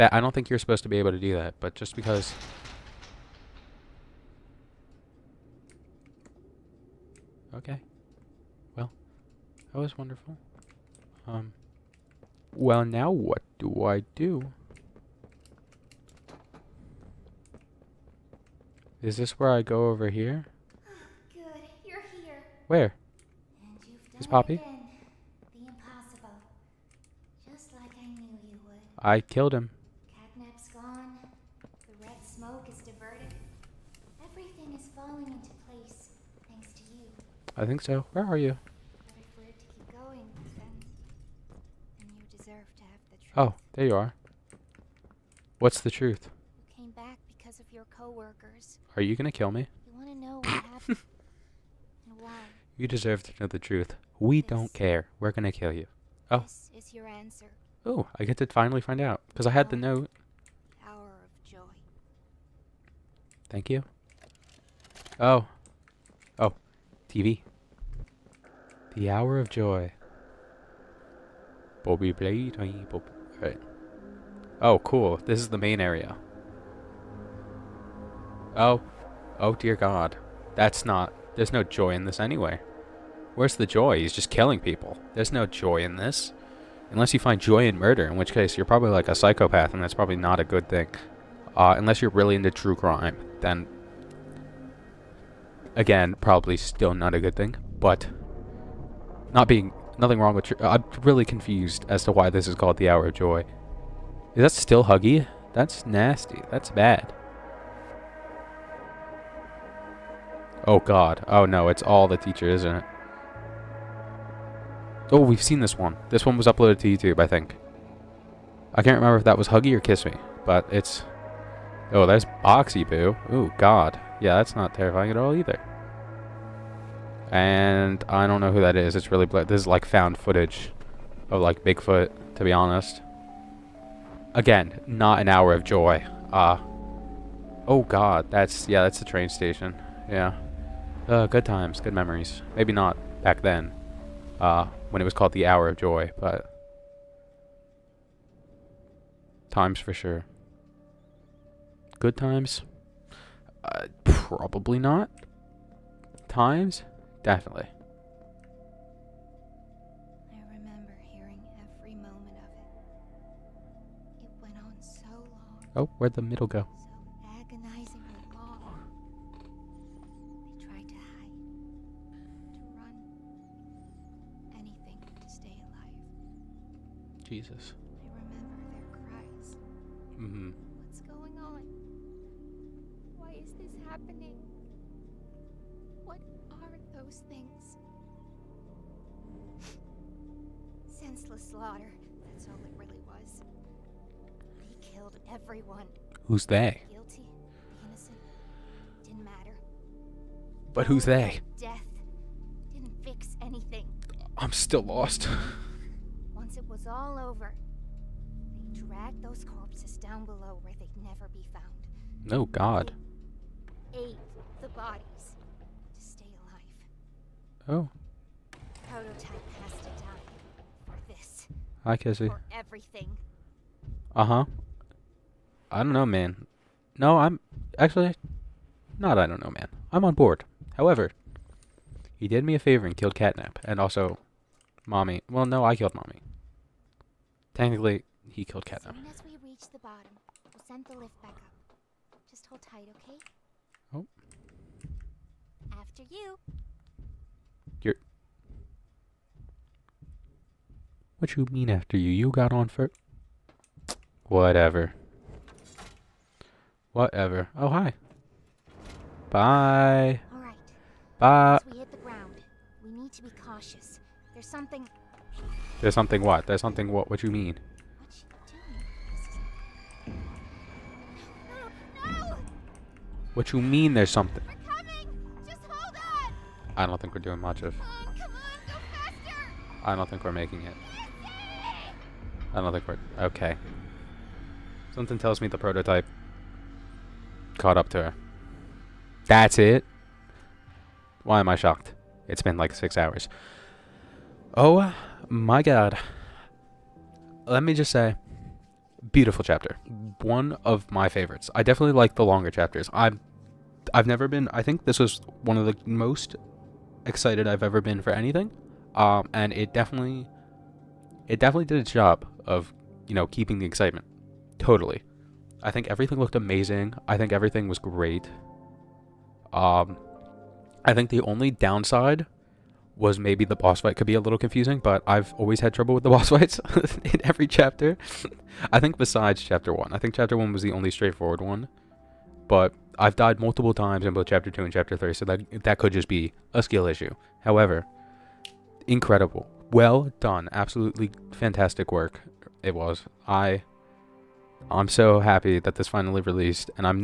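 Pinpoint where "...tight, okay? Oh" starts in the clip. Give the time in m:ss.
4:02.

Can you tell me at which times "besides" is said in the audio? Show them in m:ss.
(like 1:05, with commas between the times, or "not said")
5:28.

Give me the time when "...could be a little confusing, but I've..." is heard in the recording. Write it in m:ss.
5:23.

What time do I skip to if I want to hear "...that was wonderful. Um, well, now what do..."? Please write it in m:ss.
0:09.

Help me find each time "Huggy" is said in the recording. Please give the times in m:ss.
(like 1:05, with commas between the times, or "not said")
1:44, 1:59.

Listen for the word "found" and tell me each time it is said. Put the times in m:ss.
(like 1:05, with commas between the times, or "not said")
2:09, 3:31.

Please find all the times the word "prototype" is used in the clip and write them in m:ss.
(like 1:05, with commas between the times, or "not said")
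3:38, 4:45.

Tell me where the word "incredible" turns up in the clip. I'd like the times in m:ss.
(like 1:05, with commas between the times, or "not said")
5:38.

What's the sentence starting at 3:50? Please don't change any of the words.
However, he did me a favor and killed Catnap, and also, mommy.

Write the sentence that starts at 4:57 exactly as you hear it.
Let me just say, beautiful chapter.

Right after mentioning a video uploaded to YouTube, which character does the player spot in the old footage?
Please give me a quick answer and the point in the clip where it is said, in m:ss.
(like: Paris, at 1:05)
Boxy Boo, at 2:02.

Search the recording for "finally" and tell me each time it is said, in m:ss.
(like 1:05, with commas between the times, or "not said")
0:58, 5:45.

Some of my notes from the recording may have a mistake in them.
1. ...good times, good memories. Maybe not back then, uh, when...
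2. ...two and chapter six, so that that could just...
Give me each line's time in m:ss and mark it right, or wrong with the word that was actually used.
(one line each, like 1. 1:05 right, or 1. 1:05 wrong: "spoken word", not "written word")
1. 2:21 right
2. 5:34 wrong: "three", not "six".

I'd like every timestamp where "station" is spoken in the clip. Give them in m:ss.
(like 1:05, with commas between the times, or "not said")
2:19.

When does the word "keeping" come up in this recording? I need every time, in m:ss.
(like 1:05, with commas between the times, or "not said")
5:13.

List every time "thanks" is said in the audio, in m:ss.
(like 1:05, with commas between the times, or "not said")
0:36, 1:03.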